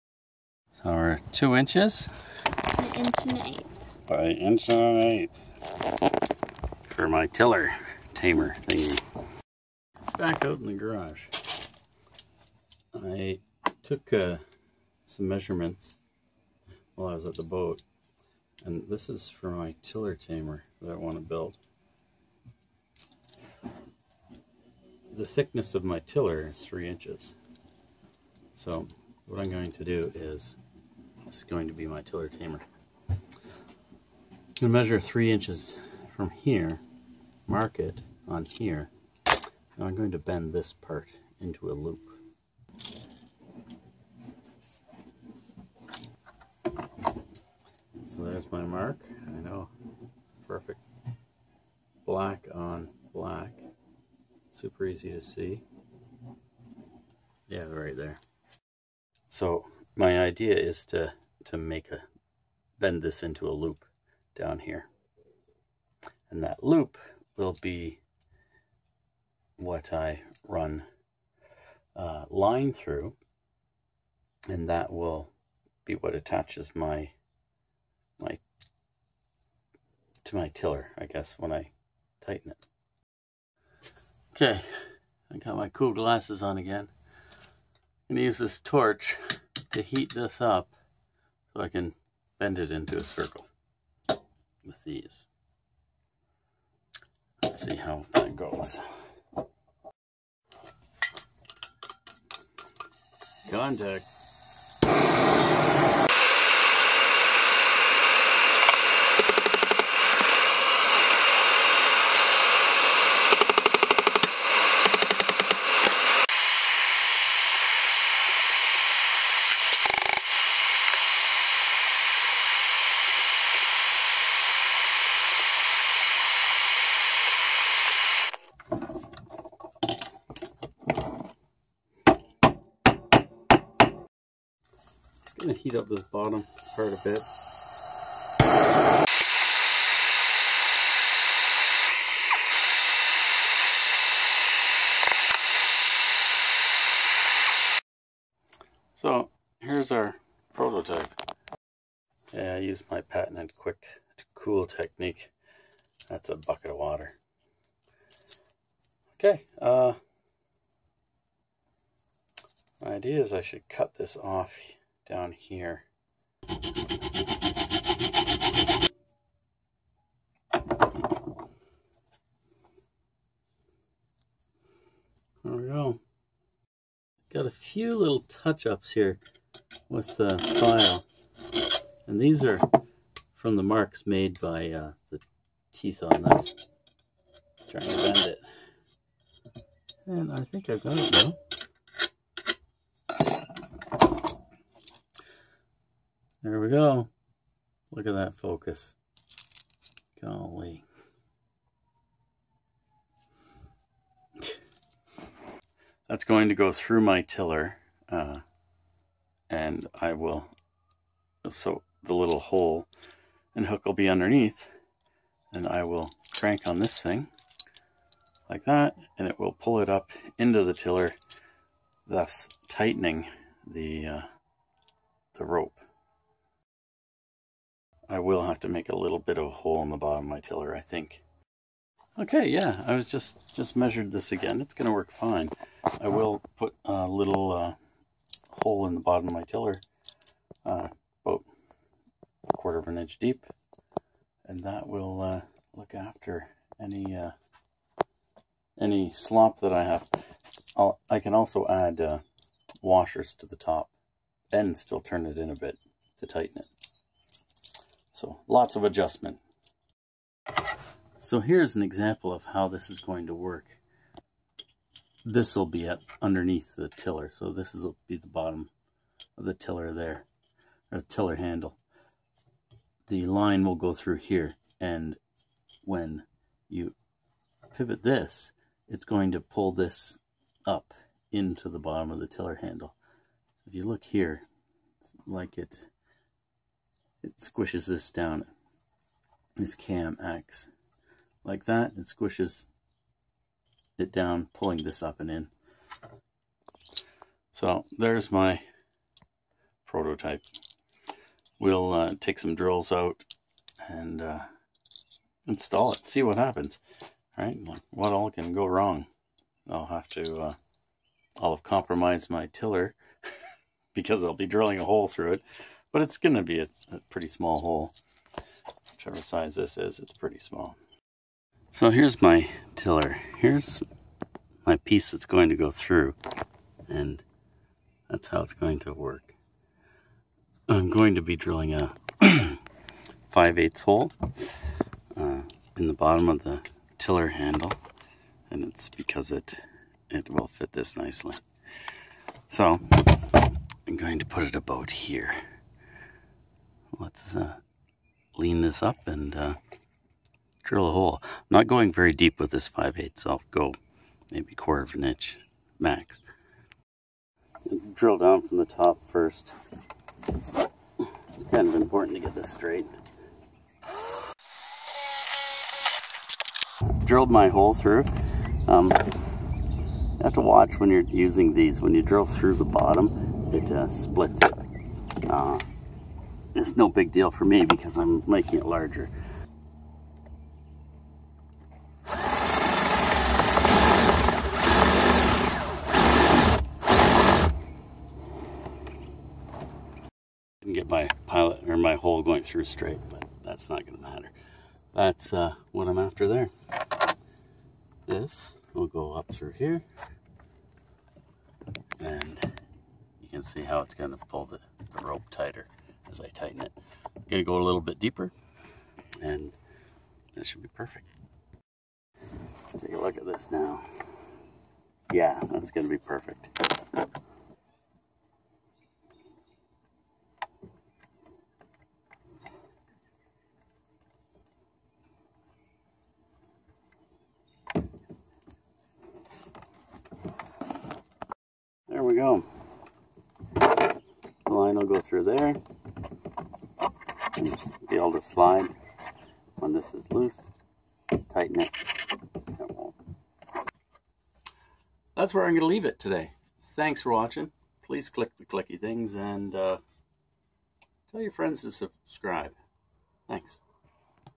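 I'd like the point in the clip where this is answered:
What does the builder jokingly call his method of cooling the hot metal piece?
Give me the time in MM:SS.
02:33.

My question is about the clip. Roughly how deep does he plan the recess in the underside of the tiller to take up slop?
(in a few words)
1/4 inch.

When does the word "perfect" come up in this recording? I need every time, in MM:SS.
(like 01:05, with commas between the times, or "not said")
00:50, 06:50, 06:55.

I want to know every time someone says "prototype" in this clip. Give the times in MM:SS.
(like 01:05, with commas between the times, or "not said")
02:30, 04:59.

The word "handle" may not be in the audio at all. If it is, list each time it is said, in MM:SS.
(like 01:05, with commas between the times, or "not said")
04:31, 04:42, 05:37.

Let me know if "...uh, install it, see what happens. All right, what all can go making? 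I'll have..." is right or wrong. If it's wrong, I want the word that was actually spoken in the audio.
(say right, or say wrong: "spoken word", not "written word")
wrong: "wrong", not "making".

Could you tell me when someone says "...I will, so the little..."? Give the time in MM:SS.
03:30.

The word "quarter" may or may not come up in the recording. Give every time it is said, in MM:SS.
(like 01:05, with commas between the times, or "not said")
04:02, 05:54.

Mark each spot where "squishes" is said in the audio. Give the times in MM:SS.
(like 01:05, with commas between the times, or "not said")
04:47, 04:52.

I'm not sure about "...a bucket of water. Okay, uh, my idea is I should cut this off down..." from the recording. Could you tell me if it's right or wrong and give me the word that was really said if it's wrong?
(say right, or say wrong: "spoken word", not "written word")
right.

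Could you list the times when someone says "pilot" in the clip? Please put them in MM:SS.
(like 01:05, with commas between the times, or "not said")
06:31.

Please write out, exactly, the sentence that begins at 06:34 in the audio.
That's uh, what I'm after there.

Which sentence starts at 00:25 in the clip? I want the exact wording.
The thickness of my tiller is three inches.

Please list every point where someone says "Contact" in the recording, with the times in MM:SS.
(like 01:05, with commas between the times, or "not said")
01:43.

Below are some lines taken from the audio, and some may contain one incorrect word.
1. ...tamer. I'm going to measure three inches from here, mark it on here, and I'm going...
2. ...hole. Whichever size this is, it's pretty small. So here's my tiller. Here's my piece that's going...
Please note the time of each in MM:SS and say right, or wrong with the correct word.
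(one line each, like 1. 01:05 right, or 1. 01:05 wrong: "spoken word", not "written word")
1. 00:32 right
2. 05:17 right.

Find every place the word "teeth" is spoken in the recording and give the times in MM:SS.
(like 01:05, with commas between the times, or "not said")
03:05.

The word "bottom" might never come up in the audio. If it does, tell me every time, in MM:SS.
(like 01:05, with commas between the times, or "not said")
02:16, 03:49, 03:58, 04:28, 04:41, 05:35, 06:12.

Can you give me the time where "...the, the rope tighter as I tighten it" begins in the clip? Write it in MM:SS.
06:44.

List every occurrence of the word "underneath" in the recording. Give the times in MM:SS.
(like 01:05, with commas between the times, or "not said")
03:34, 04:26.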